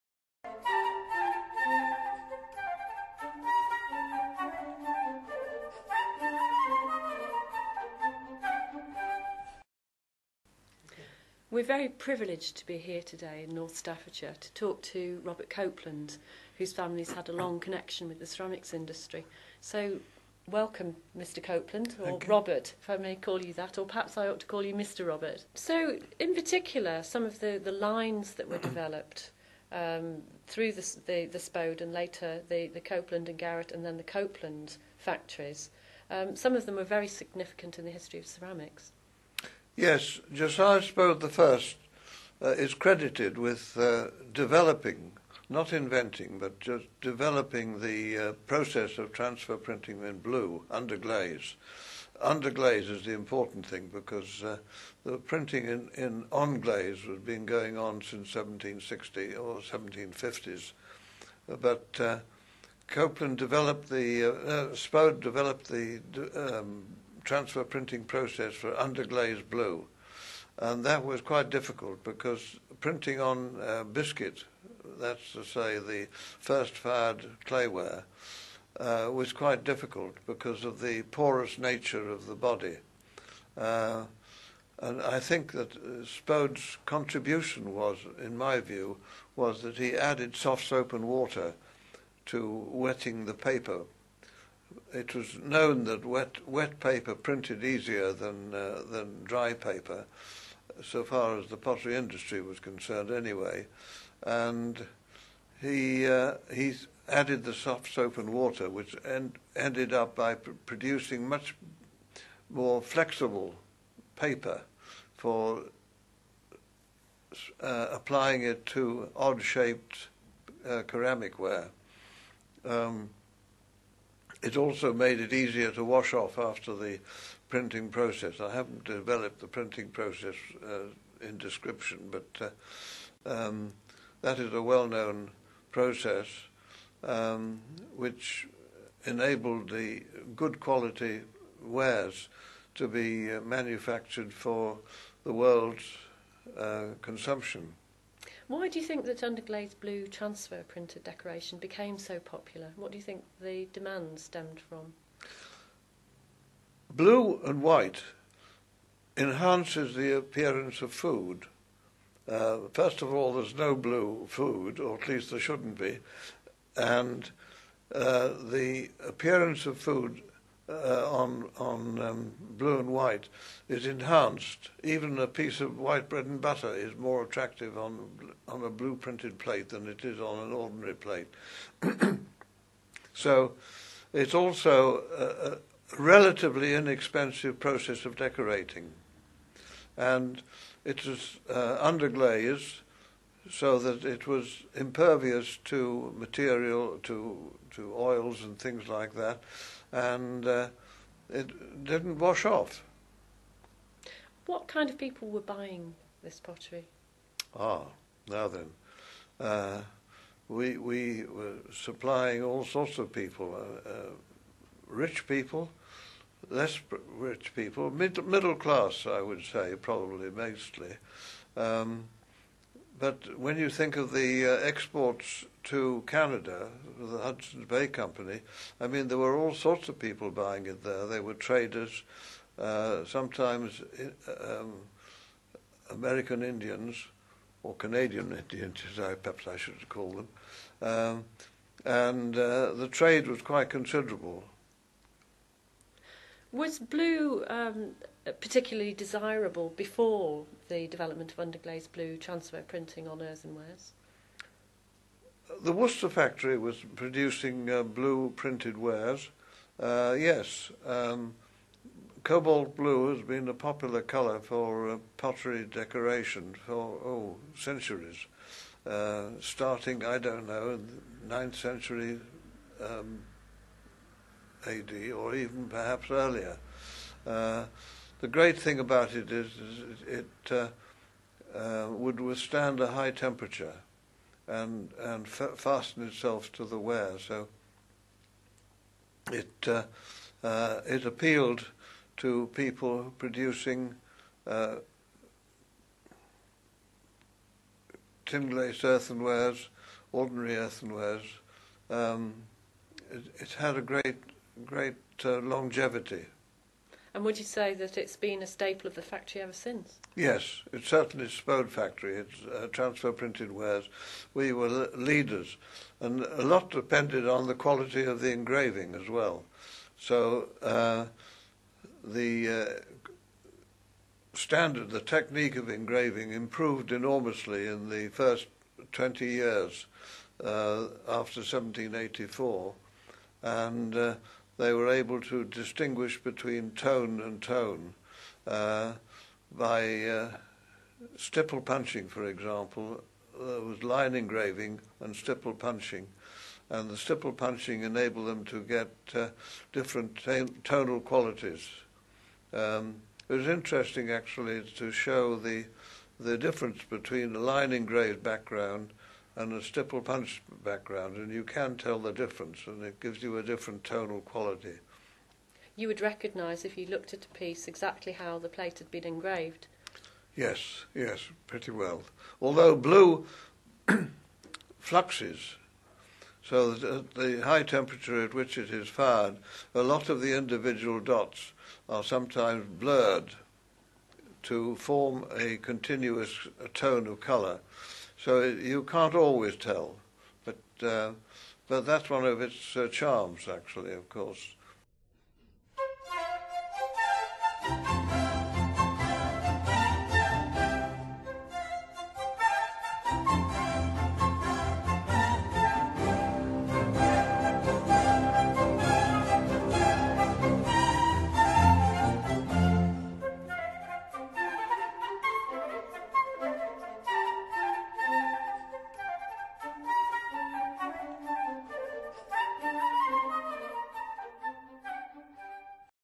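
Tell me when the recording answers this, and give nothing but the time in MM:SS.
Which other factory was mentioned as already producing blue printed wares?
04:15.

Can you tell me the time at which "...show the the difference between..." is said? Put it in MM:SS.
05:54.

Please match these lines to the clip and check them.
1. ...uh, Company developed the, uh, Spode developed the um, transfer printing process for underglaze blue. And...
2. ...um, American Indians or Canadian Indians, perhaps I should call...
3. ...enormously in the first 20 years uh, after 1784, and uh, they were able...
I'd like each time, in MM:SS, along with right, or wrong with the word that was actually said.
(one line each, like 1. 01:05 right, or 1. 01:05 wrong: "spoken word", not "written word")
1. 01:01 wrong: "Copeland", not "Company"
2. 03:54 right
3. 05:26 right.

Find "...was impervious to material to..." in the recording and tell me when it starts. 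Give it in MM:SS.
03:14.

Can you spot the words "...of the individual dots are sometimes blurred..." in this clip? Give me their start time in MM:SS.
06:20.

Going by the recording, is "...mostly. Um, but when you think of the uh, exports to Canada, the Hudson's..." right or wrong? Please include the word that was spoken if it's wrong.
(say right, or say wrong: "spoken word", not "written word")
right.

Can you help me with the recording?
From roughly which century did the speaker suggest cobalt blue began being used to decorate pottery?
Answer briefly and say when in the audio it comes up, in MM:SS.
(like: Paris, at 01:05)
Ninth century, at 04:31.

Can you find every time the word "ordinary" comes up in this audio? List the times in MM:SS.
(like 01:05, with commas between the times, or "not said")
03:00, 05:00.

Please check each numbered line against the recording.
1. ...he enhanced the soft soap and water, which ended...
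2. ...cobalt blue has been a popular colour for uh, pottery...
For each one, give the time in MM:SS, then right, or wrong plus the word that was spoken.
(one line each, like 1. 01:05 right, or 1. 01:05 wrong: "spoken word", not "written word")
1. 01:46 wrong: "added", not "enhanced"
2. 04:22 right.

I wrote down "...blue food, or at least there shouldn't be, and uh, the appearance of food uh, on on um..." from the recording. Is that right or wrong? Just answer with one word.
right.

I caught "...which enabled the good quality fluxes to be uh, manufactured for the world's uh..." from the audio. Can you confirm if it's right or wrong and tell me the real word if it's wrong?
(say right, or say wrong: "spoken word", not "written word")
wrong: "wares", not "fluxes".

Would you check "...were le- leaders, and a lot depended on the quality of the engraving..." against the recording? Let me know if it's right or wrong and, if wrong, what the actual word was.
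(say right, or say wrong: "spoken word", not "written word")
right.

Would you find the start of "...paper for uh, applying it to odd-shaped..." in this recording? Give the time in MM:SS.
01:54.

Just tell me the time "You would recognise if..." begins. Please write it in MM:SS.
06:05.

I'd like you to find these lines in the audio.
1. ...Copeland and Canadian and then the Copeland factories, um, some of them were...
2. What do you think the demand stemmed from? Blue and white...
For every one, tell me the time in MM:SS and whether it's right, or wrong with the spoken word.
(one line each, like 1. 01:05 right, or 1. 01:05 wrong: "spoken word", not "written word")
1. 00:32 wrong: "Garrett", not "Canadian"
2. 02:32 right.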